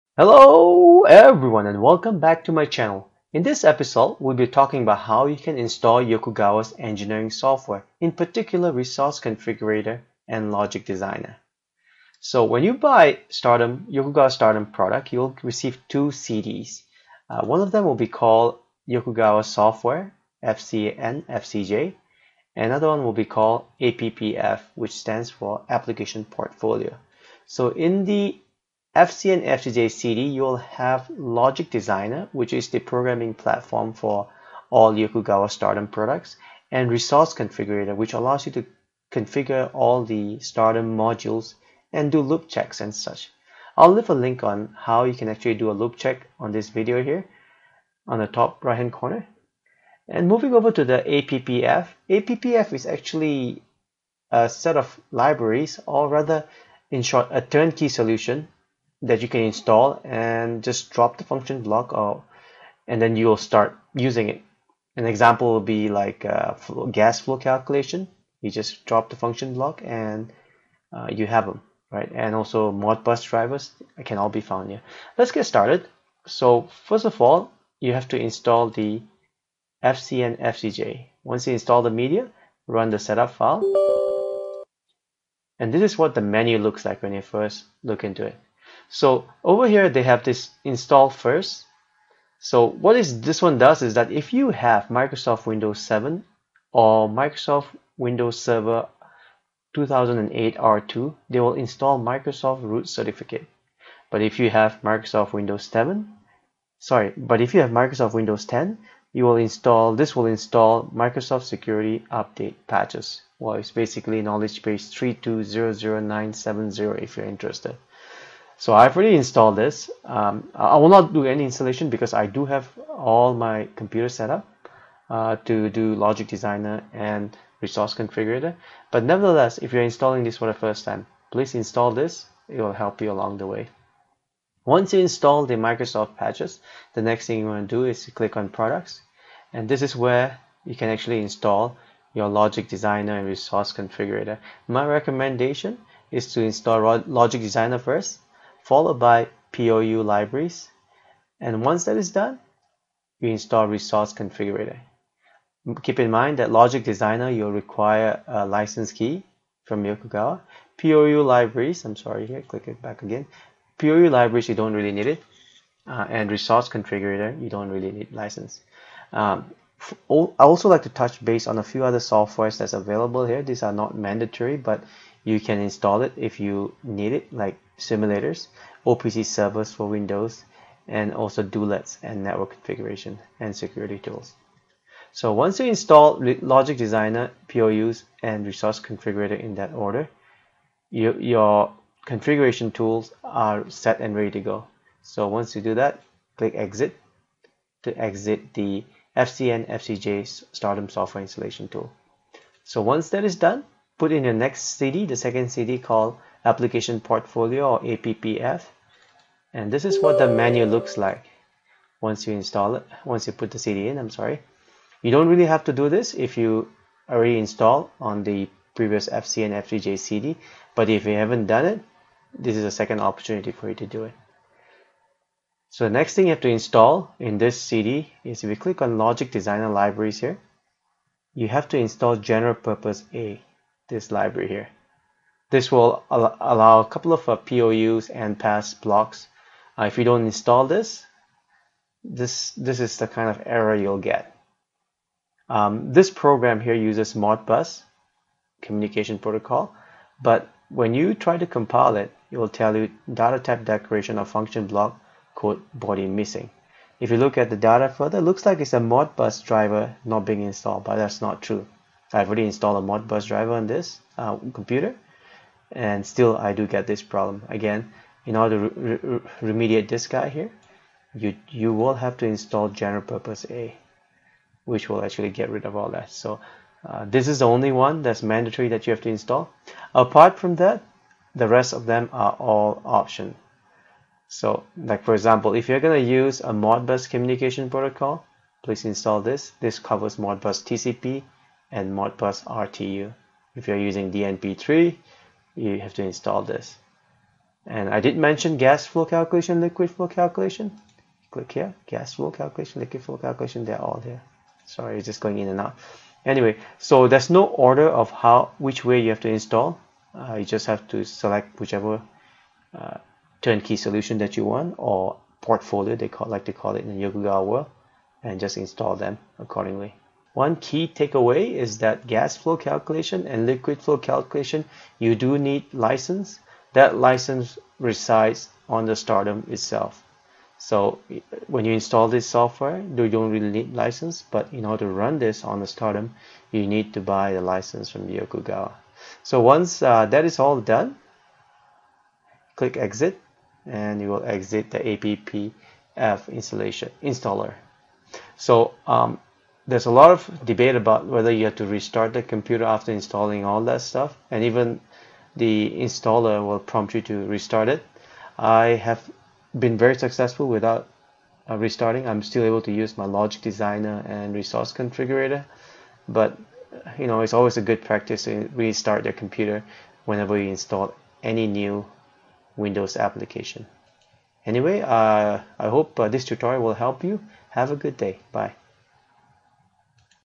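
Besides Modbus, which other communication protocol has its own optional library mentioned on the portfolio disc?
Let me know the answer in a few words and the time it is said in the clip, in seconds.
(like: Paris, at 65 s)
DNP3, at 294 s.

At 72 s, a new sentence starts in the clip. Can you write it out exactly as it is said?
And also Modbus drivers can all be found here.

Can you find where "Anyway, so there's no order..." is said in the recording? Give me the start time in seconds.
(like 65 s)
306 s.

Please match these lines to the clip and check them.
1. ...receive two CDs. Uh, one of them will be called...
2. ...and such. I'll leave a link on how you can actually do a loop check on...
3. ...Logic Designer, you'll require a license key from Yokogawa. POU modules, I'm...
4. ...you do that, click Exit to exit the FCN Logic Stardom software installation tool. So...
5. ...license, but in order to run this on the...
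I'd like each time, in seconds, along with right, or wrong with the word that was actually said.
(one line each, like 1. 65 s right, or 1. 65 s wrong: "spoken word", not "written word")
1. 15 s right
2. 42 s right
3. 156 s wrong: "libraries", not "modules"
4. 195 s wrong: "FCJ", not "Logic"
5. 333 s right.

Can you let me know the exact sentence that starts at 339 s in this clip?
So once uh, that is all done, click exit and you will exit the APPF installation installer.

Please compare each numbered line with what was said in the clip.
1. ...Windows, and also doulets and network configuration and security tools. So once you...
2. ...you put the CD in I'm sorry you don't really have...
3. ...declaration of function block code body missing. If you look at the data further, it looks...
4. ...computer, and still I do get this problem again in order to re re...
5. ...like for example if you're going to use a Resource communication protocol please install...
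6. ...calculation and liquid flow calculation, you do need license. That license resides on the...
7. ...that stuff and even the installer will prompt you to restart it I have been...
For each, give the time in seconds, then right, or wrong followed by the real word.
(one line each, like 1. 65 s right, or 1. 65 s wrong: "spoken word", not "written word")
1. 179 s right
2. 213 s right
3. 253 s right
4. 264 s right
5. 284 s wrong: "Modbus", not "Resource"
6. 322 s right
7. 353 s right.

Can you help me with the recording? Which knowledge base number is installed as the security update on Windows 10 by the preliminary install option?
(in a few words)
3200970.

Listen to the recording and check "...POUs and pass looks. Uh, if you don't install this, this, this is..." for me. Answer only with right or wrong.
wrong.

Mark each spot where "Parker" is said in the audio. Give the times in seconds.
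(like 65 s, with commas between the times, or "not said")
not said.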